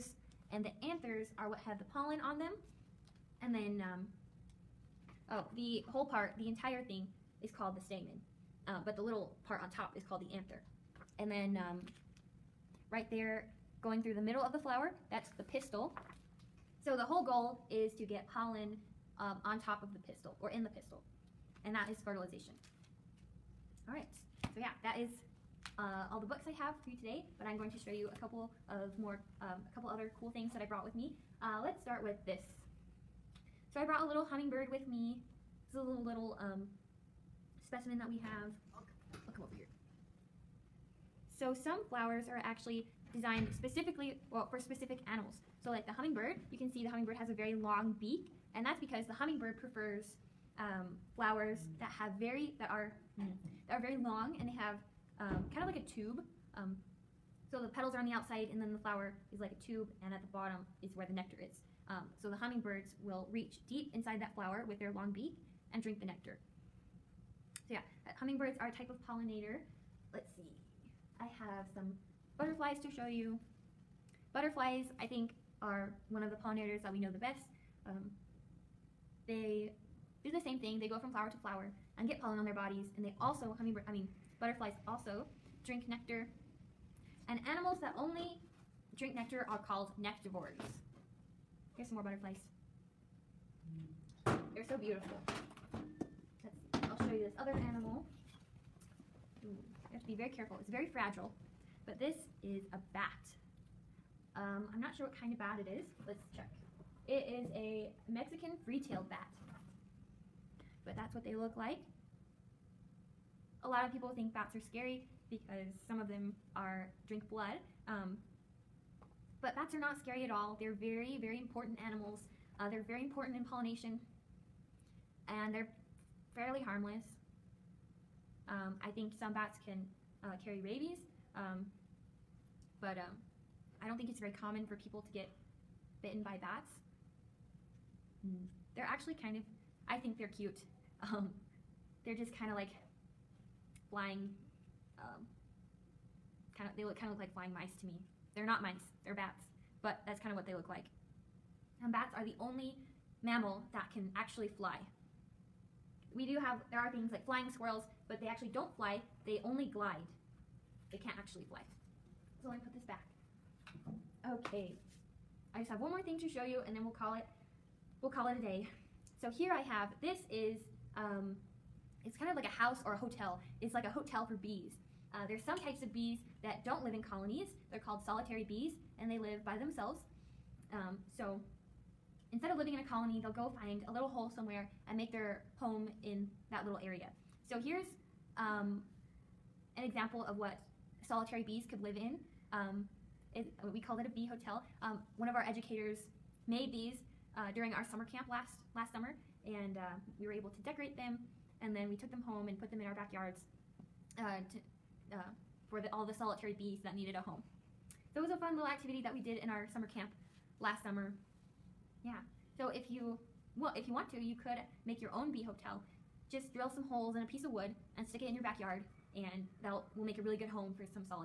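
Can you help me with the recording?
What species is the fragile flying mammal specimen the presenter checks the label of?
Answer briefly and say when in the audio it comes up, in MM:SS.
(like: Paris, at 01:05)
Mexican free-tailed bat, at 01:48.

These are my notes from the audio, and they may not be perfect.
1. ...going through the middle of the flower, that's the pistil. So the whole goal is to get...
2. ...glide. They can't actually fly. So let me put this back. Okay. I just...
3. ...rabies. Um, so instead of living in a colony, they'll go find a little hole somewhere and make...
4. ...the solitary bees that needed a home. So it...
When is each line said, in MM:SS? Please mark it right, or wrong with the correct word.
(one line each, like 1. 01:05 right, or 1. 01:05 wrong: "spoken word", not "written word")
1. 00:13 right
2. 02:39 right
3. 02:59 wrong: "themselves", not "rabies"
4. 03:26 right.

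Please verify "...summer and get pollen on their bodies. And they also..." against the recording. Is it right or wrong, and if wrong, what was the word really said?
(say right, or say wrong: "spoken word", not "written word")
wrong: "flower", not "summer".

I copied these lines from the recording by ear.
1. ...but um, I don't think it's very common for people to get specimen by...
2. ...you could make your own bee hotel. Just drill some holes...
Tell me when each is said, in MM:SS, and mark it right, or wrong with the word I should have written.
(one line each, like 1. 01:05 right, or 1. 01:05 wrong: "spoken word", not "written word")
1. 02:12 wrong: "bitten", not "specimen"
2. 03:34 right.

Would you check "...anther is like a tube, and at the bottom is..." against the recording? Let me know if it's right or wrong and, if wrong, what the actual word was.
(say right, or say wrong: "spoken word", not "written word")
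wrong: "flower", not "anther".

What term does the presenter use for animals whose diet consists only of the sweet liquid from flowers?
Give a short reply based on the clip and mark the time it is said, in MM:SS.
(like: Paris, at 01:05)
nectivores, at 01:29.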